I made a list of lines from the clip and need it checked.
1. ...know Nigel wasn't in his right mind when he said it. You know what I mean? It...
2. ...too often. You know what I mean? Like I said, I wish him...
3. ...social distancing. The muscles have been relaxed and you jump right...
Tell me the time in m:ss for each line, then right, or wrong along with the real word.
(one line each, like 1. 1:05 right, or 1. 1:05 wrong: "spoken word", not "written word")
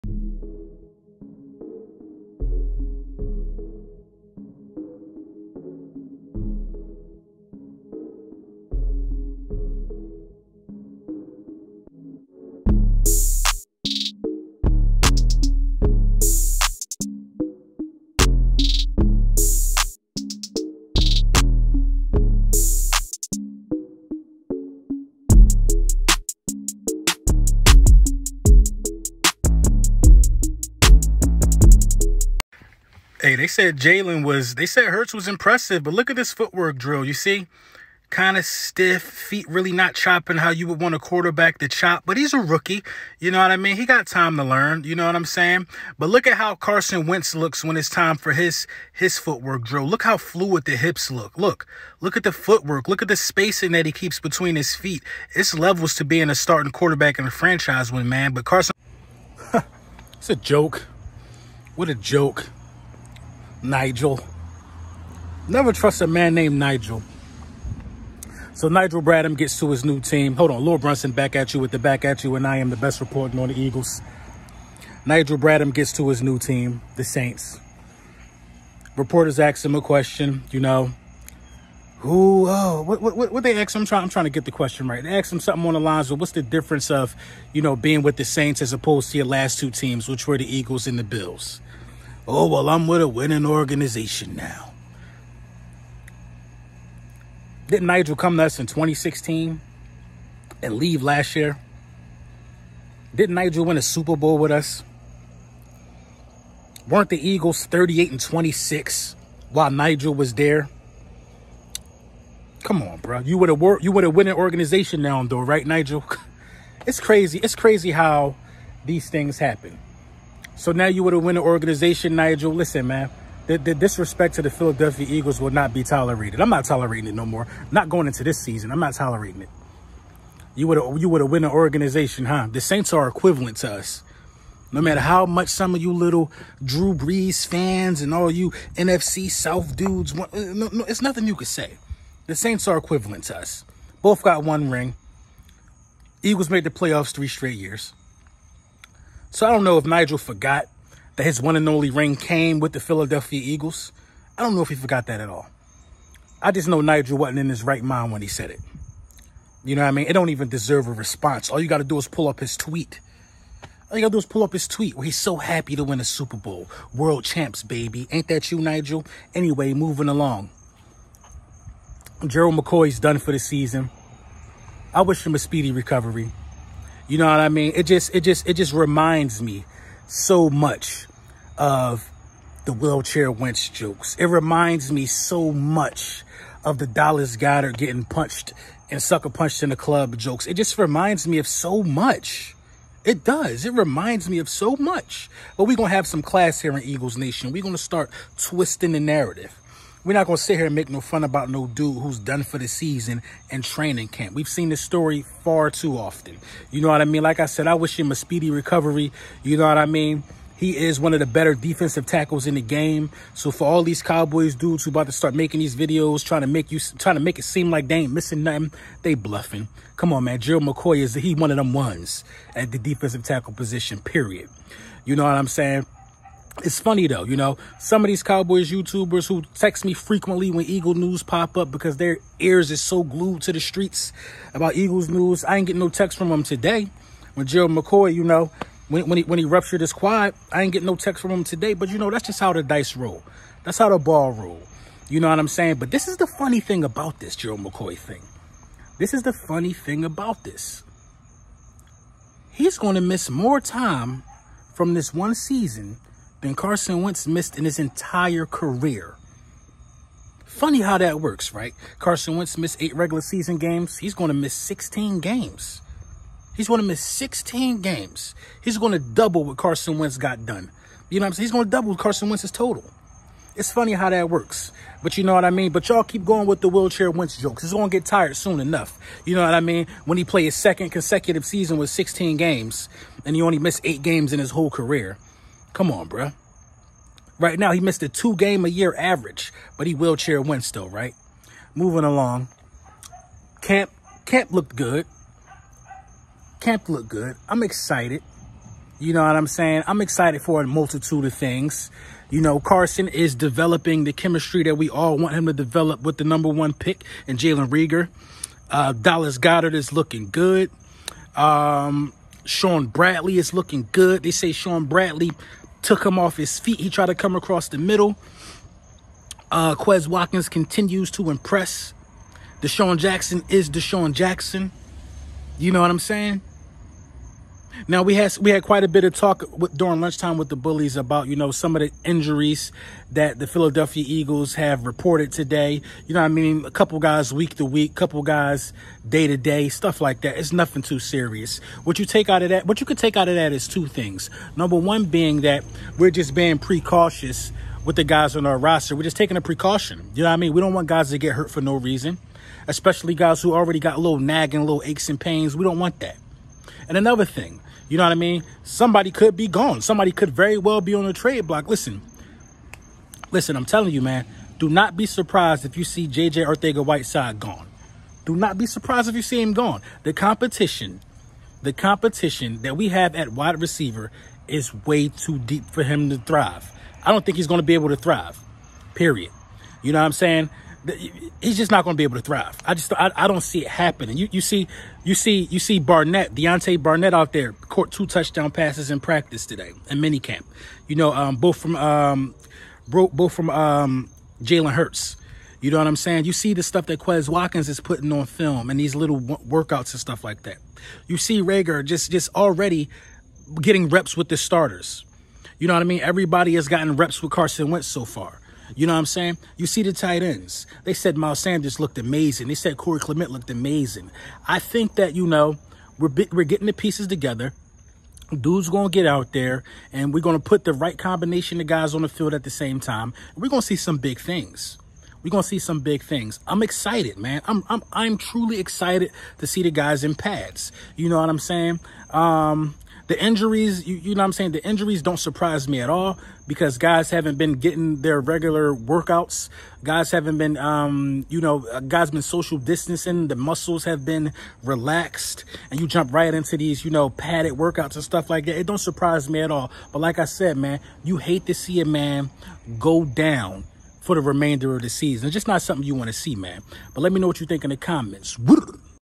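1. 2:36 right
2. 3:25 right
3. 7:22 right.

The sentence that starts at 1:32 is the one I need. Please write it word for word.
Oh, well, I'm with a winning organization now.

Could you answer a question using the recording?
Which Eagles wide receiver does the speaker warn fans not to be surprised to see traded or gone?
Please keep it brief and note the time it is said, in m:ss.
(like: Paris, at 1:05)
JJ Arcega-Whiteside, at 6:06.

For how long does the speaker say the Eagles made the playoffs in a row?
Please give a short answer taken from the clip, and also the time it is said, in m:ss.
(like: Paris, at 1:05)
three straight years, at 2:27.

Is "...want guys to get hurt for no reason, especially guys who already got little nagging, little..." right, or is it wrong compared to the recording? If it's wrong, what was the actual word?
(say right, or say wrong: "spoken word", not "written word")
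right.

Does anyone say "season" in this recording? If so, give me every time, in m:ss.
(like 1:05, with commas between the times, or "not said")
2:08, 2:53, 3:22, 4:15, 4:23, 4:41, 7:34.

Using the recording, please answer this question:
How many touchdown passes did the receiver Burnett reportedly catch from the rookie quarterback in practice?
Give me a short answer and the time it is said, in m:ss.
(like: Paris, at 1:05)
2, at 6:27.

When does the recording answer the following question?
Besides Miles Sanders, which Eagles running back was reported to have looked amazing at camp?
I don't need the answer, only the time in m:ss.
6:52.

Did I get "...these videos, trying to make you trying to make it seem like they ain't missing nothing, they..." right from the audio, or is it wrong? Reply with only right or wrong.
right.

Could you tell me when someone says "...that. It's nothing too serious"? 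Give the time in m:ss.
5:40.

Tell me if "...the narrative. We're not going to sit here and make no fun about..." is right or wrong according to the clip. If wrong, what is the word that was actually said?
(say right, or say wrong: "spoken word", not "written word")
right.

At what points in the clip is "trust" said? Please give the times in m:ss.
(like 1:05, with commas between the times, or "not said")
1:05.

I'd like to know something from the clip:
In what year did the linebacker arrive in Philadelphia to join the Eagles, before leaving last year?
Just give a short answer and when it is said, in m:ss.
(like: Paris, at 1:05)
2016, at 1:38.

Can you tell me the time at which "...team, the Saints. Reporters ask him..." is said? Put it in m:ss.
1:16.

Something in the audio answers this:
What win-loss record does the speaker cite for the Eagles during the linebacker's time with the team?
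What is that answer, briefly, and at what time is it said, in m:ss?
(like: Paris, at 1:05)
38-26, at 1:47.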